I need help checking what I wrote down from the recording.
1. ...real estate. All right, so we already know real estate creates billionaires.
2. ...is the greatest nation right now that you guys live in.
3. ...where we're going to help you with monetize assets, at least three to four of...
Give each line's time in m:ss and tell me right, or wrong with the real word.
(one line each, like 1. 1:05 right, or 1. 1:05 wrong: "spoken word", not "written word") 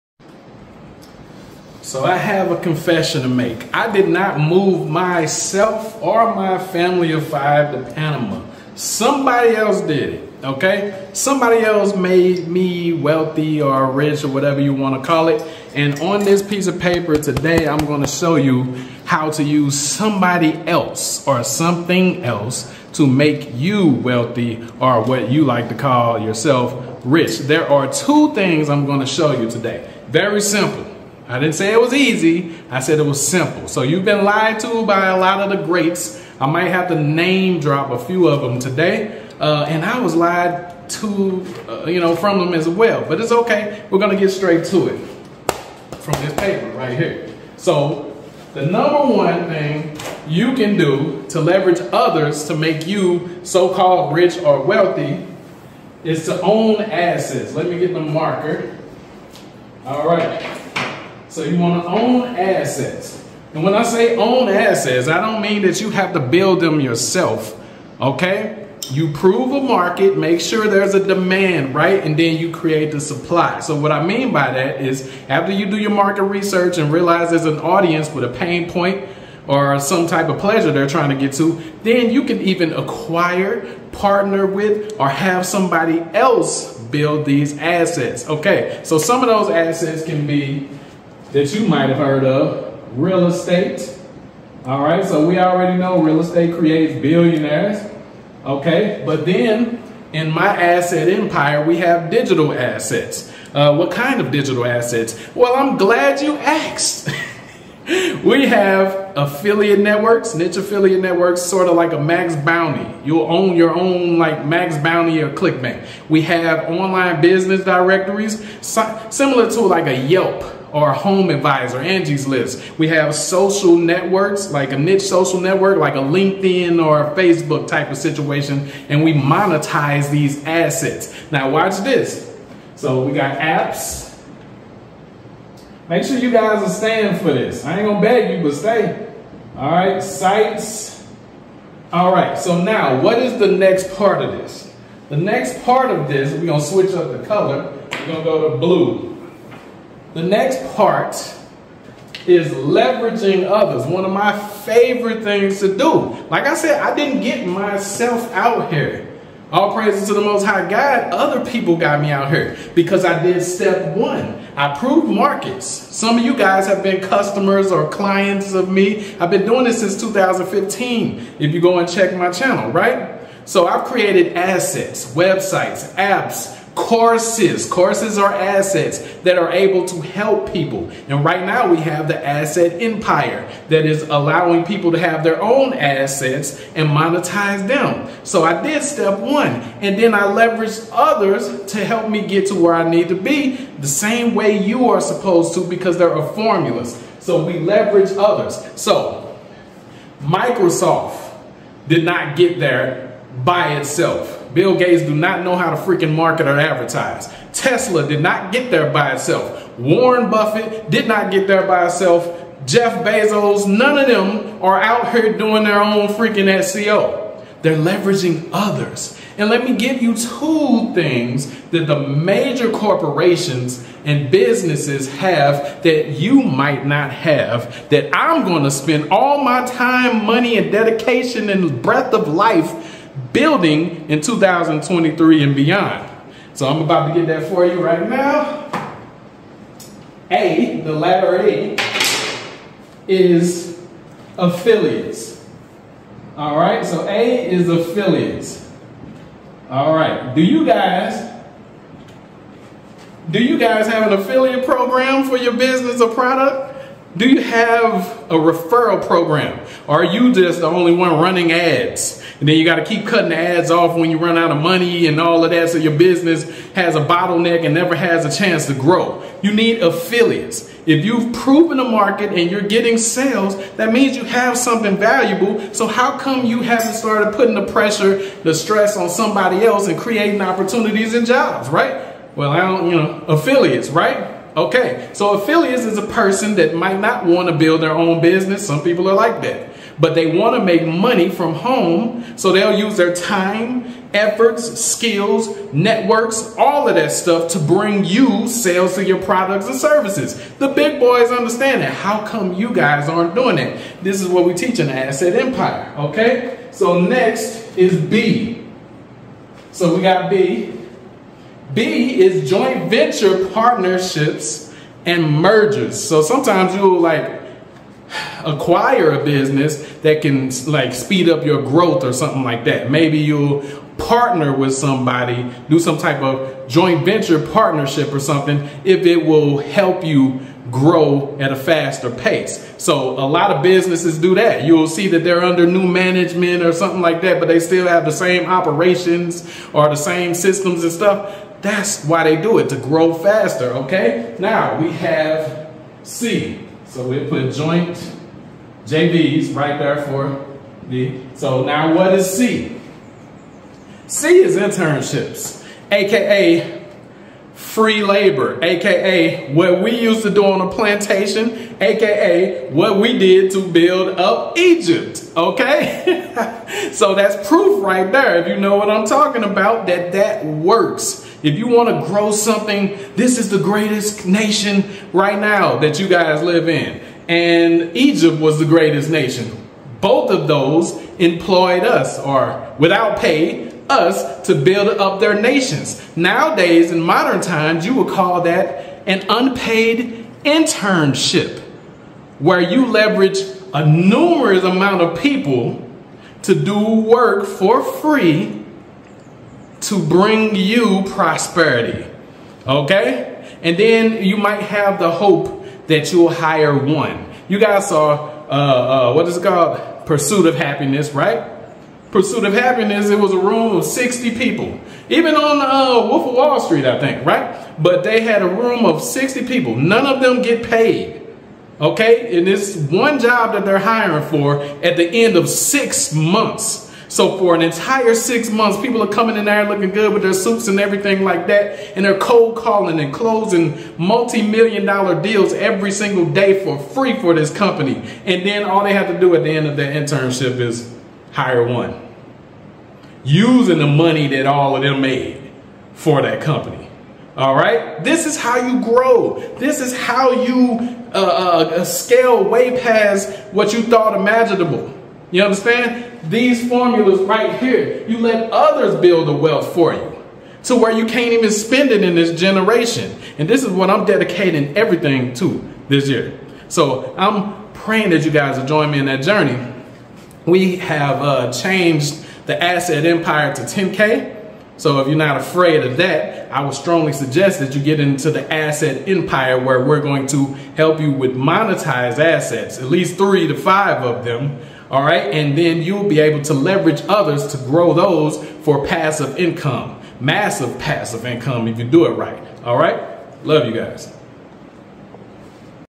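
1. 1:32 right
2. 6:13 right
3. 7:59 wrong: "five", not "four".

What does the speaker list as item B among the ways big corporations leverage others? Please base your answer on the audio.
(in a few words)
joint venture partnerships and mergers.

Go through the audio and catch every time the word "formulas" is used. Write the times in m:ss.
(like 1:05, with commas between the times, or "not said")
3:16, 7:36.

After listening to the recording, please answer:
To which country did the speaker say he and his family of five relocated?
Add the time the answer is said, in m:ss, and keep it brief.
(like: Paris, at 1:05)
Panama, at 0:07.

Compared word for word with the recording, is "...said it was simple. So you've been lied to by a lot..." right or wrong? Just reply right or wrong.
right.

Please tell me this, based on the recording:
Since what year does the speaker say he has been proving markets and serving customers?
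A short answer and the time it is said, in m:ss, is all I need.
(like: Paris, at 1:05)
2015, at 2:49.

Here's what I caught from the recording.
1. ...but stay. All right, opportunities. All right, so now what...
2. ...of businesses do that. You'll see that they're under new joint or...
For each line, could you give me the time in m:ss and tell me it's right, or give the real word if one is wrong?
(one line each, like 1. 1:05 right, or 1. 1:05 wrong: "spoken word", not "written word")
1. 2:18 wrong: "sites", not "opportunities"
2. 5:33 wrong: "management", not "joint".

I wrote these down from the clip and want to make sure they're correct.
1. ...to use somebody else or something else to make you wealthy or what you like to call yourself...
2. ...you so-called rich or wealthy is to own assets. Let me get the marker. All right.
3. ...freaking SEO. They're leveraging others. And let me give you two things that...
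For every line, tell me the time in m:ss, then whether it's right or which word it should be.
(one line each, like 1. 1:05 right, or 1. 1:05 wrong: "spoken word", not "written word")
1. 0:19 right
2. 0:52 right
3. 3:36 right.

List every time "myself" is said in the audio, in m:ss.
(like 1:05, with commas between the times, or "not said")
0:04, 2:37.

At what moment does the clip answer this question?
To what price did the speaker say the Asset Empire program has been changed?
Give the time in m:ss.
7:53.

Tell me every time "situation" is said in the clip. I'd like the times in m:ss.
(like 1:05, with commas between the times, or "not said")
2:07.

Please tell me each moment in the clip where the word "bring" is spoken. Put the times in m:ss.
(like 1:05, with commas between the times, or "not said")
4:57, 6:40.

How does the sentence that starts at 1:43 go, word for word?
Uh, what kind of digital assets?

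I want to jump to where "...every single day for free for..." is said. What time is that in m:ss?
7:15.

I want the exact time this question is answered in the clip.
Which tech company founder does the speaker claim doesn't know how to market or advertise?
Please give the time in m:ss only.
3:24.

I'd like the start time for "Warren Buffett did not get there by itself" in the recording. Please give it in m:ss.
3:29.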